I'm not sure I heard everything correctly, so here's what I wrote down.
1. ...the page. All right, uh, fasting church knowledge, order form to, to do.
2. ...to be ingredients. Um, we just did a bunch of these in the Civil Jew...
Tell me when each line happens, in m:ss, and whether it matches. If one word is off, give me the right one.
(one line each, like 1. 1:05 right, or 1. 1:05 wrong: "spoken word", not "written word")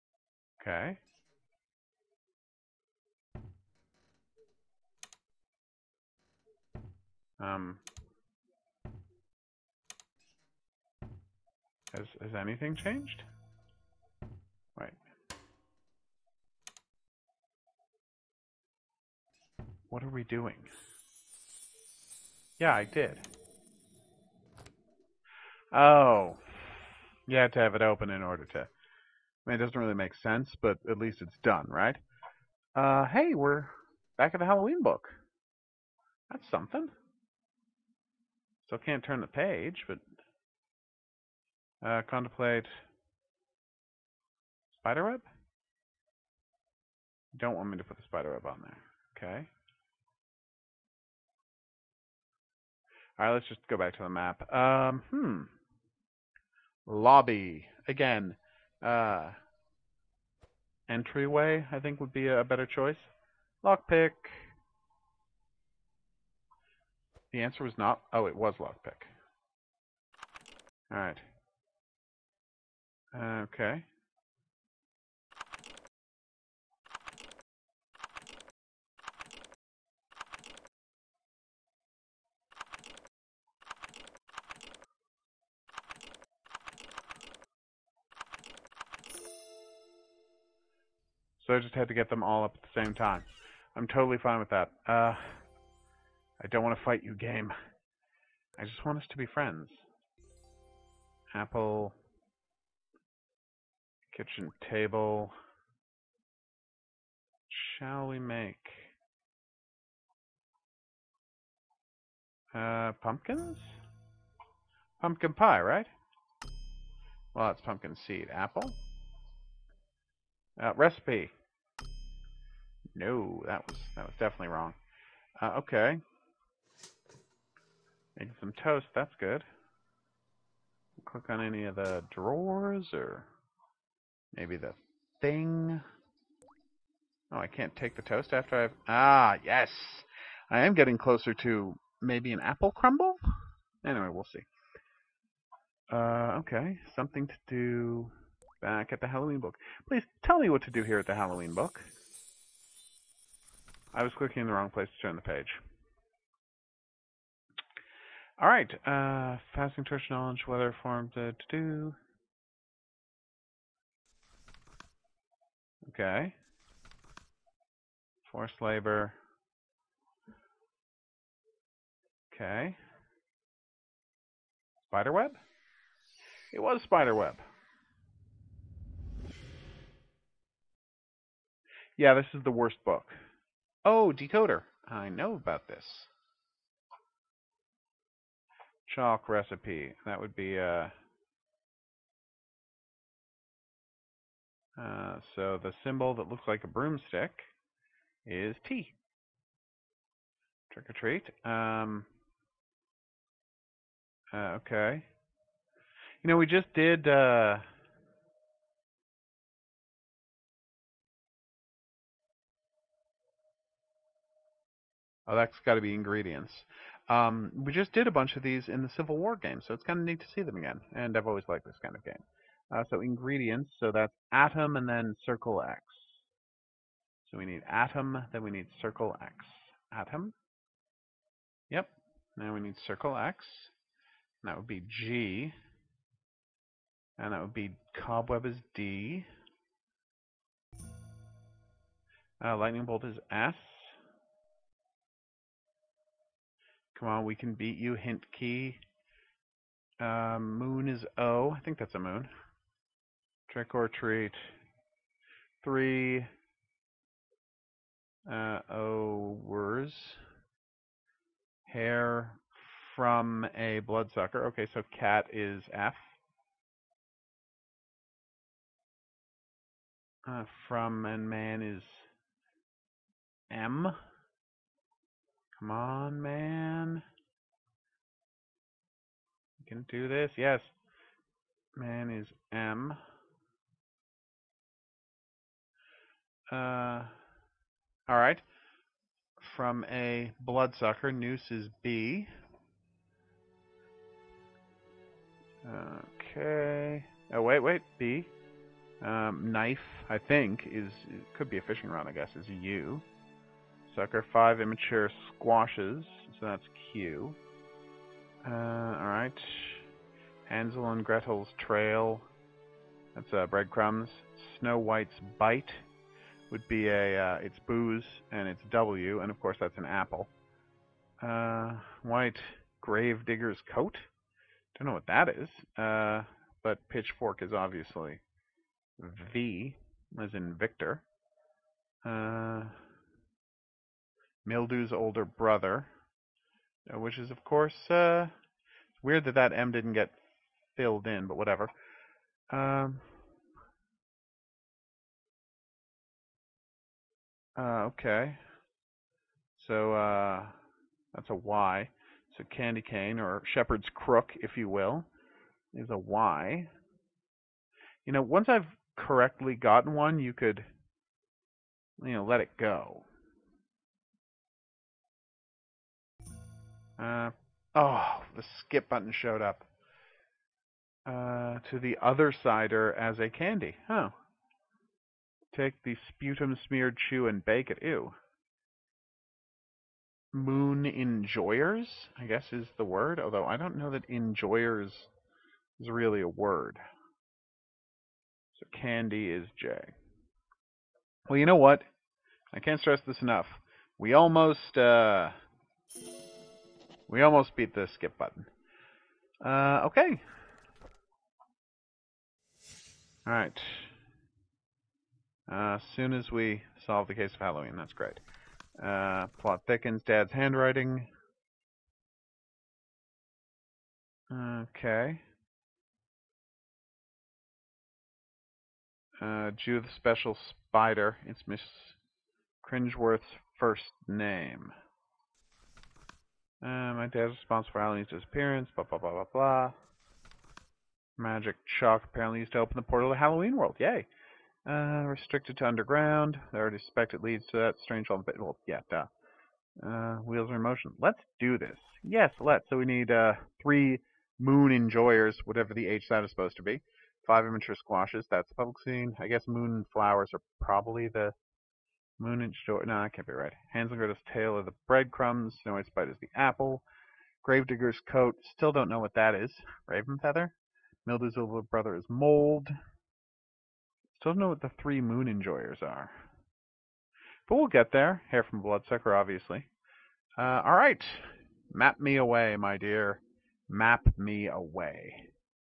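1. 2:35 wrong: "weather", not "order"
2. 3:35 wrong: "War", not "Jew".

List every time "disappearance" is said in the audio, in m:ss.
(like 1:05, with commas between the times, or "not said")
7:08.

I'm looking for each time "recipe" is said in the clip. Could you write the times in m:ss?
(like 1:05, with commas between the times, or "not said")
2:00, 3:09.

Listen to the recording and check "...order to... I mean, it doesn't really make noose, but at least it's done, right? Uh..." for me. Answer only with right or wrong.
wrong.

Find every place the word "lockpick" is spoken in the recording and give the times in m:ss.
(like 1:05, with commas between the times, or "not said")
1:03, 1:08.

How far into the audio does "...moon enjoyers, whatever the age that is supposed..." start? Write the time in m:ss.
7:24.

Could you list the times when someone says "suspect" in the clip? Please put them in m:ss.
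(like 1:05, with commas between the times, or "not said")
7:16.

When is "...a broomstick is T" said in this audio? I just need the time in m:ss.
3:16.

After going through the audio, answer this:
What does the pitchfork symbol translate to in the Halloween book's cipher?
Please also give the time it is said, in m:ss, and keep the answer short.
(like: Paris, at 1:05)
V, at 5:26.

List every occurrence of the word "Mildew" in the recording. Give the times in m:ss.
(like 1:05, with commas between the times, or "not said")
5:34, 7:41.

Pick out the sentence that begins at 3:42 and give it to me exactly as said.
Uh, so ingredients, so that's atom and then circle X.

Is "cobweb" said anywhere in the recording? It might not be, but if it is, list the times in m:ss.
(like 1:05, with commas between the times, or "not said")
3:58.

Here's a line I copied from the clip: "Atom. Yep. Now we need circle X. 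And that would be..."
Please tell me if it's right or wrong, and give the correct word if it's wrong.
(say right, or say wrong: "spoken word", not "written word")
right.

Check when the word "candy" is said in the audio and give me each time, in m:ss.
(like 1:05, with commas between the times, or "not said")
5:52, 6:13, 6:28.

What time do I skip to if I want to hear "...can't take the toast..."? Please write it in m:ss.
2:17.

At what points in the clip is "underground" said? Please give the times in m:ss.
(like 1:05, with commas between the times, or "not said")
7:15.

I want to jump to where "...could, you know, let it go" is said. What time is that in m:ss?
6:00.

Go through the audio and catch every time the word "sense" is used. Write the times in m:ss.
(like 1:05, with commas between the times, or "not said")
0:30.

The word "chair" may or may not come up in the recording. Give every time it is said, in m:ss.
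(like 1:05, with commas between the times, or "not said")
not said.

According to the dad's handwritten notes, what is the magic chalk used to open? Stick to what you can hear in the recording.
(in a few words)
the portal to Halloween World.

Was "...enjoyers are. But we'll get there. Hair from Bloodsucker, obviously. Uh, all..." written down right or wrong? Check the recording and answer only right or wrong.
right.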